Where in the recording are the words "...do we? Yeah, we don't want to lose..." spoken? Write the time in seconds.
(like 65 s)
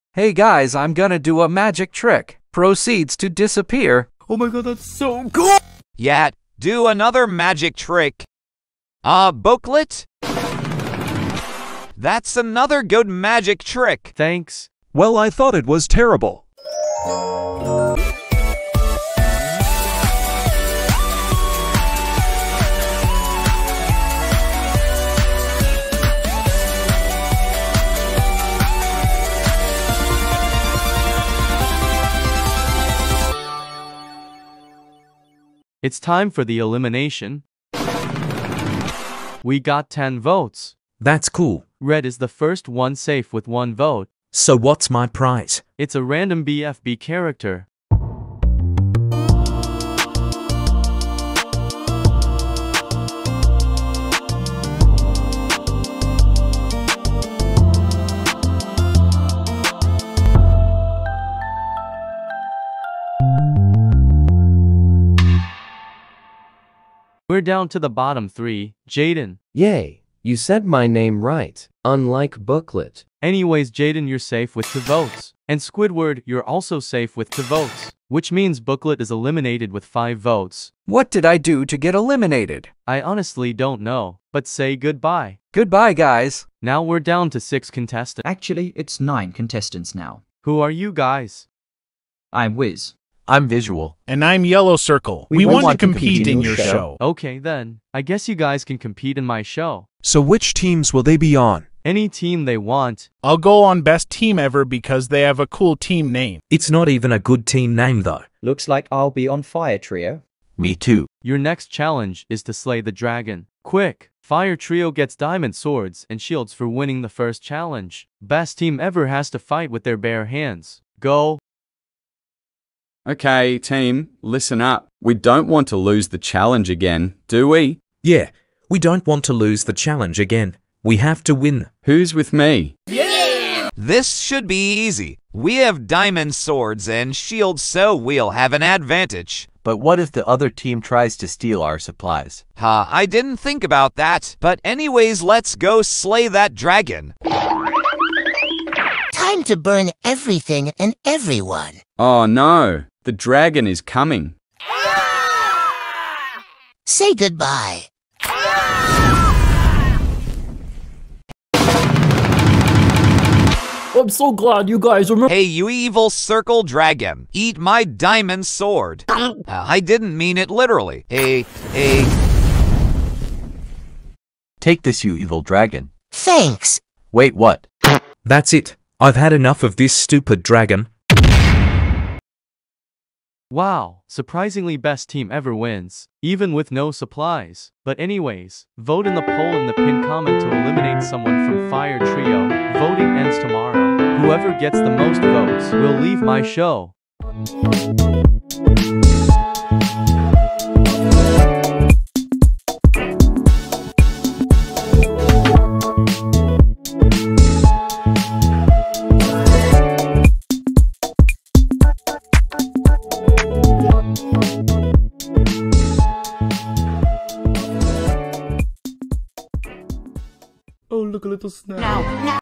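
127 s.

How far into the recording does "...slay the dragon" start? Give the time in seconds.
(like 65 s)
112 s.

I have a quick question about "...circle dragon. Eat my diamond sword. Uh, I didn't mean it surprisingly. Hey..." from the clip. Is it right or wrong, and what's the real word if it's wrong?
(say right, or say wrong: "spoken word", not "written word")
wrong: "literally", not "surprisingly".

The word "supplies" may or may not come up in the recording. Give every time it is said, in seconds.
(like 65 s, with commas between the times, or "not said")
141 s, 186 s.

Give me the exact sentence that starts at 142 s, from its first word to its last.
Ha, I didn't think about that.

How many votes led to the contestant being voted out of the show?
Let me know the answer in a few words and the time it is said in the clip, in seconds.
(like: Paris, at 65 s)
5, at 79 s.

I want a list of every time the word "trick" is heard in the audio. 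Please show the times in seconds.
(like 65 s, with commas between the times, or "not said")
1 s, 7 s, 13 s.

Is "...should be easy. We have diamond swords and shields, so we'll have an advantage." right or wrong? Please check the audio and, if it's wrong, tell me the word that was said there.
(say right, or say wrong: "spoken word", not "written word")
right.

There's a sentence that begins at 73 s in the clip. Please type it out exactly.
Anyways, Jaden, you're safe with two votes.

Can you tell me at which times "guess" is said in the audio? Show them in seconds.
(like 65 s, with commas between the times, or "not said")
98 s.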